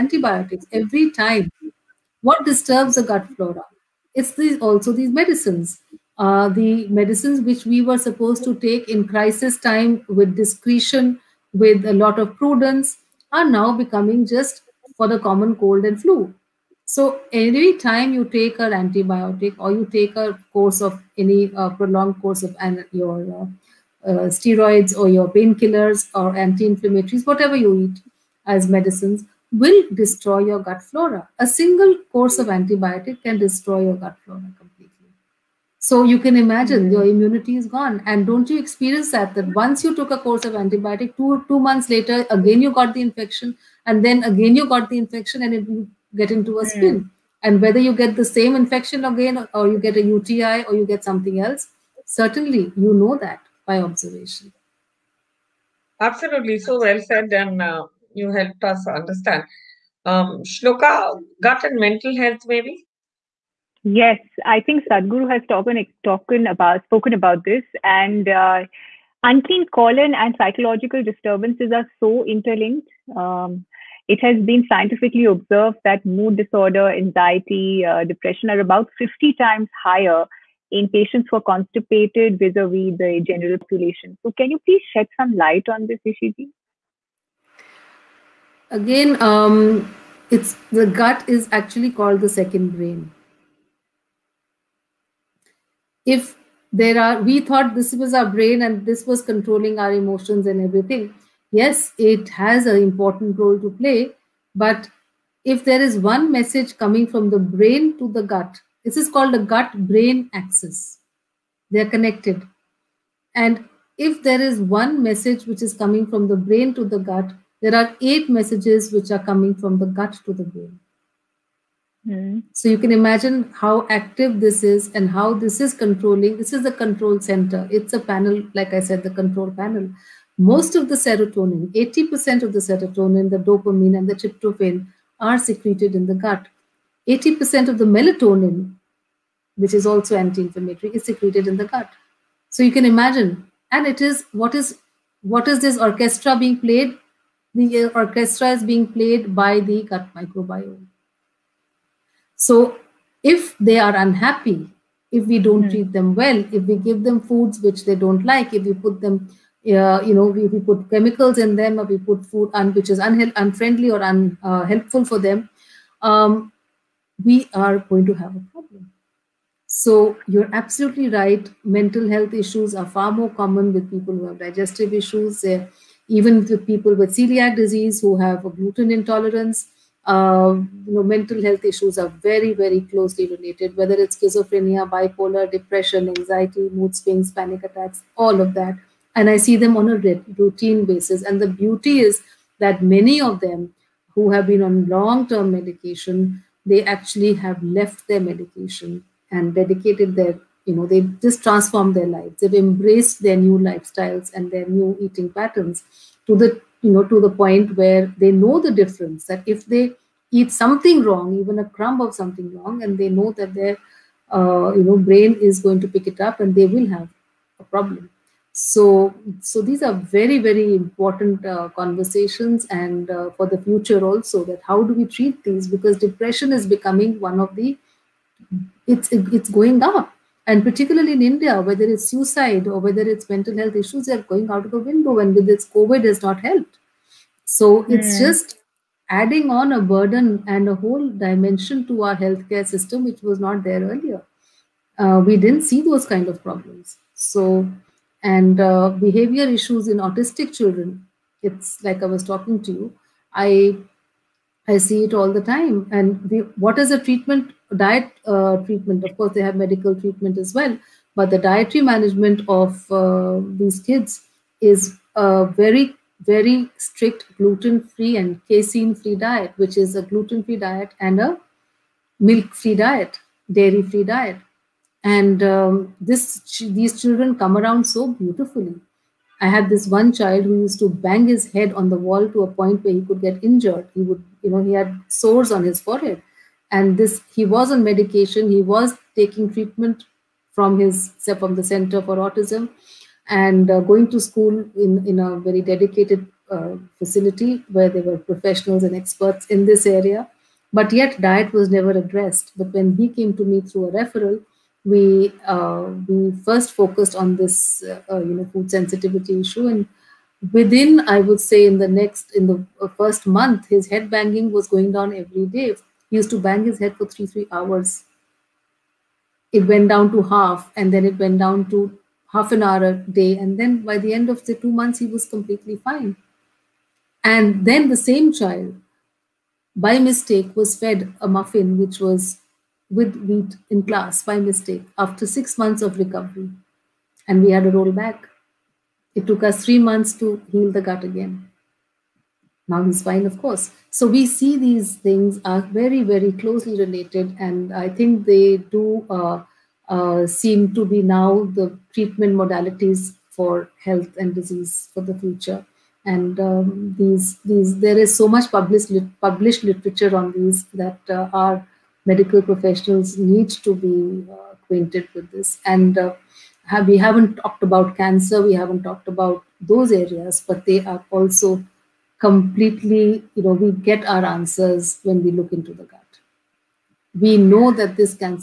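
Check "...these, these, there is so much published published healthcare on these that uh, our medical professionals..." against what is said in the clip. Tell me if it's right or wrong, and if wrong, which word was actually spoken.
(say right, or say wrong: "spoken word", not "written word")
wrong: "literature", not "healthcare".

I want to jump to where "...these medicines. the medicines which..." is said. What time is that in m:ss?
0:04.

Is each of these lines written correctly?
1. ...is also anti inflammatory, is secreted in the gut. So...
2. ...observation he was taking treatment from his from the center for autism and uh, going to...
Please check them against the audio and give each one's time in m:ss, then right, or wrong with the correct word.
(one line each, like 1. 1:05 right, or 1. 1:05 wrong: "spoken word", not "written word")
1. 2:19 right
2. 4:47 wrong: "medication", not "observation".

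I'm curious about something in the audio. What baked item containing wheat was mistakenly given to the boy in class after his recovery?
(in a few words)
muffin.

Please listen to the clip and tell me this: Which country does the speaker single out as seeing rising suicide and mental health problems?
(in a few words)
India.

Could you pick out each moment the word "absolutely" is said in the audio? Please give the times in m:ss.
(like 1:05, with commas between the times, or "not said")
0:55, 2:50.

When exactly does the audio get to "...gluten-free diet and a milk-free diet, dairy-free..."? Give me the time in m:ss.
4:30.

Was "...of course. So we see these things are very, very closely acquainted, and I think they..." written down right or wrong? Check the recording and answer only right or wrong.
wrong.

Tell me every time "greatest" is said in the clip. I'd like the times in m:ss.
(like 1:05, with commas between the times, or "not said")
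not said.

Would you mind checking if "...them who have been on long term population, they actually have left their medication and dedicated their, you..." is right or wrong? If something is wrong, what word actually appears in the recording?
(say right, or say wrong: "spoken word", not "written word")
wrong: "medication", not "population".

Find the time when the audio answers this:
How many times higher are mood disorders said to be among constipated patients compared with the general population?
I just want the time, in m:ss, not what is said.
1:18.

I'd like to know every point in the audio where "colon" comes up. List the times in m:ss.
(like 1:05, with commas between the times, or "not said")
1:09.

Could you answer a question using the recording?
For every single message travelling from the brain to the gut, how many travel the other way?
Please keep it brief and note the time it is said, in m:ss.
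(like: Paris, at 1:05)
8, at 1:58.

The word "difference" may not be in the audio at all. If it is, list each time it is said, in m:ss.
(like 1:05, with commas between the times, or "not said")
3:28.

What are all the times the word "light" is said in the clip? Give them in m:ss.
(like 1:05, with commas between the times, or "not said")
1:25.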